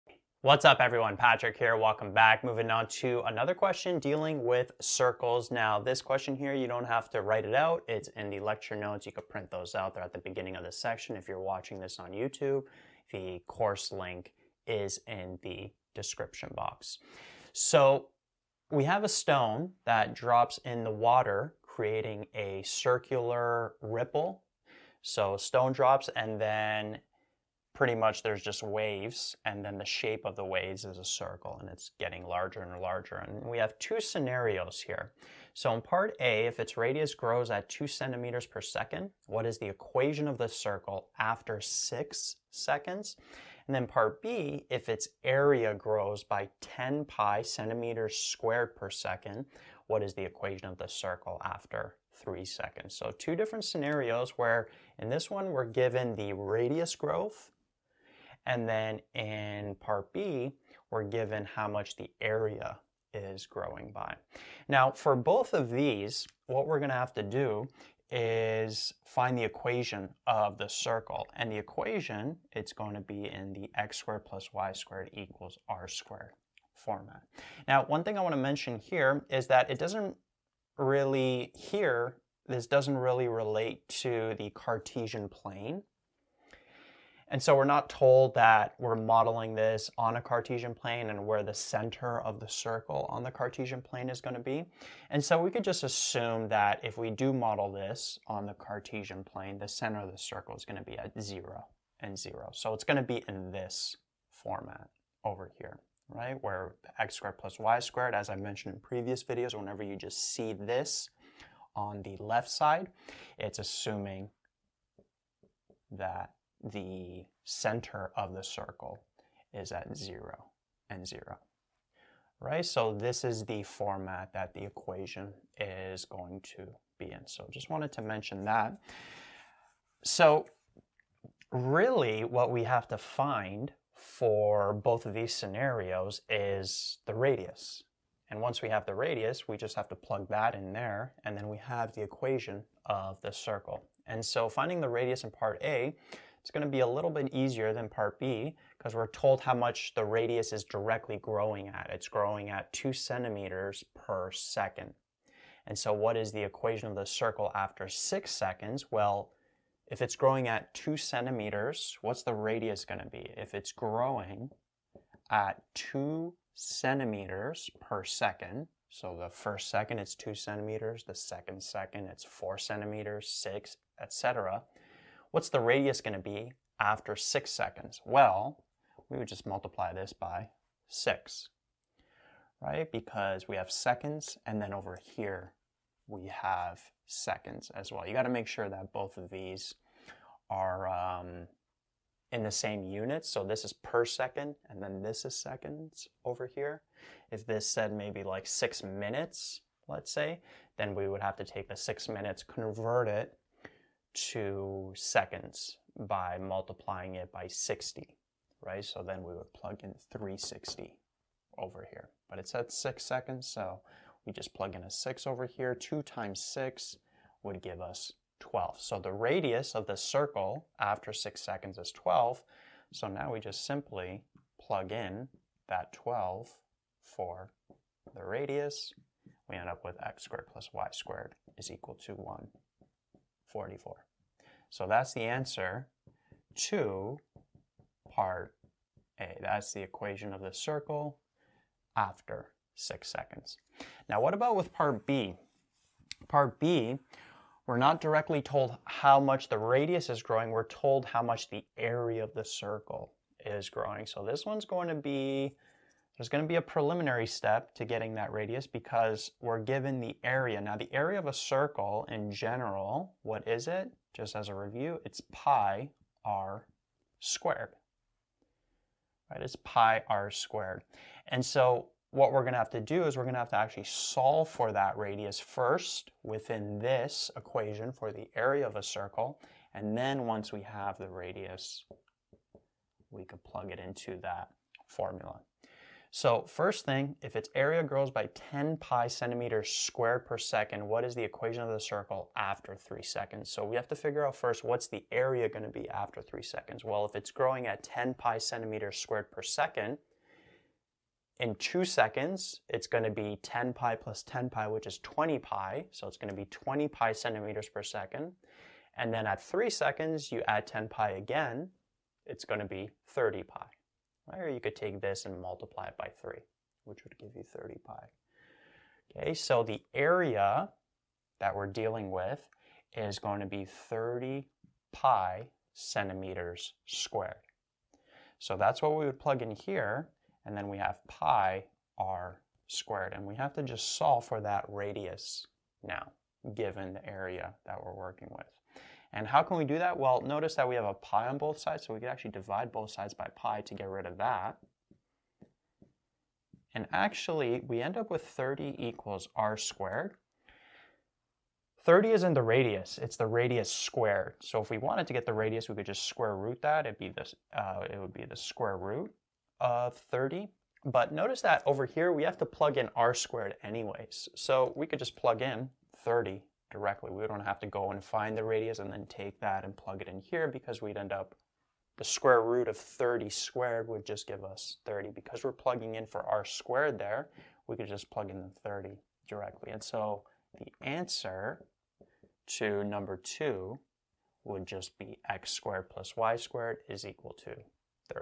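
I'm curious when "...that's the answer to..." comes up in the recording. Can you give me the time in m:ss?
3:54.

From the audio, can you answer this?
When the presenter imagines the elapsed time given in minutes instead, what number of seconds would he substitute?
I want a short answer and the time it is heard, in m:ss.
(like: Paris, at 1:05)
360, at 3:30.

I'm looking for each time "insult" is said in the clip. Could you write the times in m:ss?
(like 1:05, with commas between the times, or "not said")
not said.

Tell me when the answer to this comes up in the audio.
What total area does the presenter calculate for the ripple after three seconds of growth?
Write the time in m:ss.
5:23.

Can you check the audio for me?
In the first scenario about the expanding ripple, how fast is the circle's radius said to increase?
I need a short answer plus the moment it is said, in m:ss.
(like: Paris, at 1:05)
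2 centimeters per second, at 0:37.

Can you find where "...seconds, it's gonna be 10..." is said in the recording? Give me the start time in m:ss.
5:01.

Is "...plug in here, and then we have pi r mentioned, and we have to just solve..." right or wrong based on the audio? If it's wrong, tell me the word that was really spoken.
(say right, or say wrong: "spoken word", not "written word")
wrong: "squared", not "mentioned".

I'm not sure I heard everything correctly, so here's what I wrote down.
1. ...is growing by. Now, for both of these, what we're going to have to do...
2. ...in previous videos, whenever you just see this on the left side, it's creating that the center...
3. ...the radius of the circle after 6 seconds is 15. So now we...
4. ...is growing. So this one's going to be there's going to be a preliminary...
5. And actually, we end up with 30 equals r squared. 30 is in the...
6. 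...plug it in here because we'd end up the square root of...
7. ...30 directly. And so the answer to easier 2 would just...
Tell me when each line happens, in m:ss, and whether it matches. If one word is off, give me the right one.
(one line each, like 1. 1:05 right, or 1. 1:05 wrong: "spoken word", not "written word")
1. 1:03 right
2. 1:48 wrong: "assuming", not "creating"
3. 3:38 wrong: "12", not "15"
4. 4:13 right
5. 5:46 right
6. 6:09 right
7. 6:18 wrong: "number", not "easier".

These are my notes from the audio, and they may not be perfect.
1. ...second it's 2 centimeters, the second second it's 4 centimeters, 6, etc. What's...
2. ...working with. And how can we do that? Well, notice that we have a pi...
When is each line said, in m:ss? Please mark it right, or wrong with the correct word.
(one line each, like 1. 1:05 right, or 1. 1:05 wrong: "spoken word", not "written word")
1. 2:49 right
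2. 5:37 right.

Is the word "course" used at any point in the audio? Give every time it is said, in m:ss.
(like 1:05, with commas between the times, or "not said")
0:13.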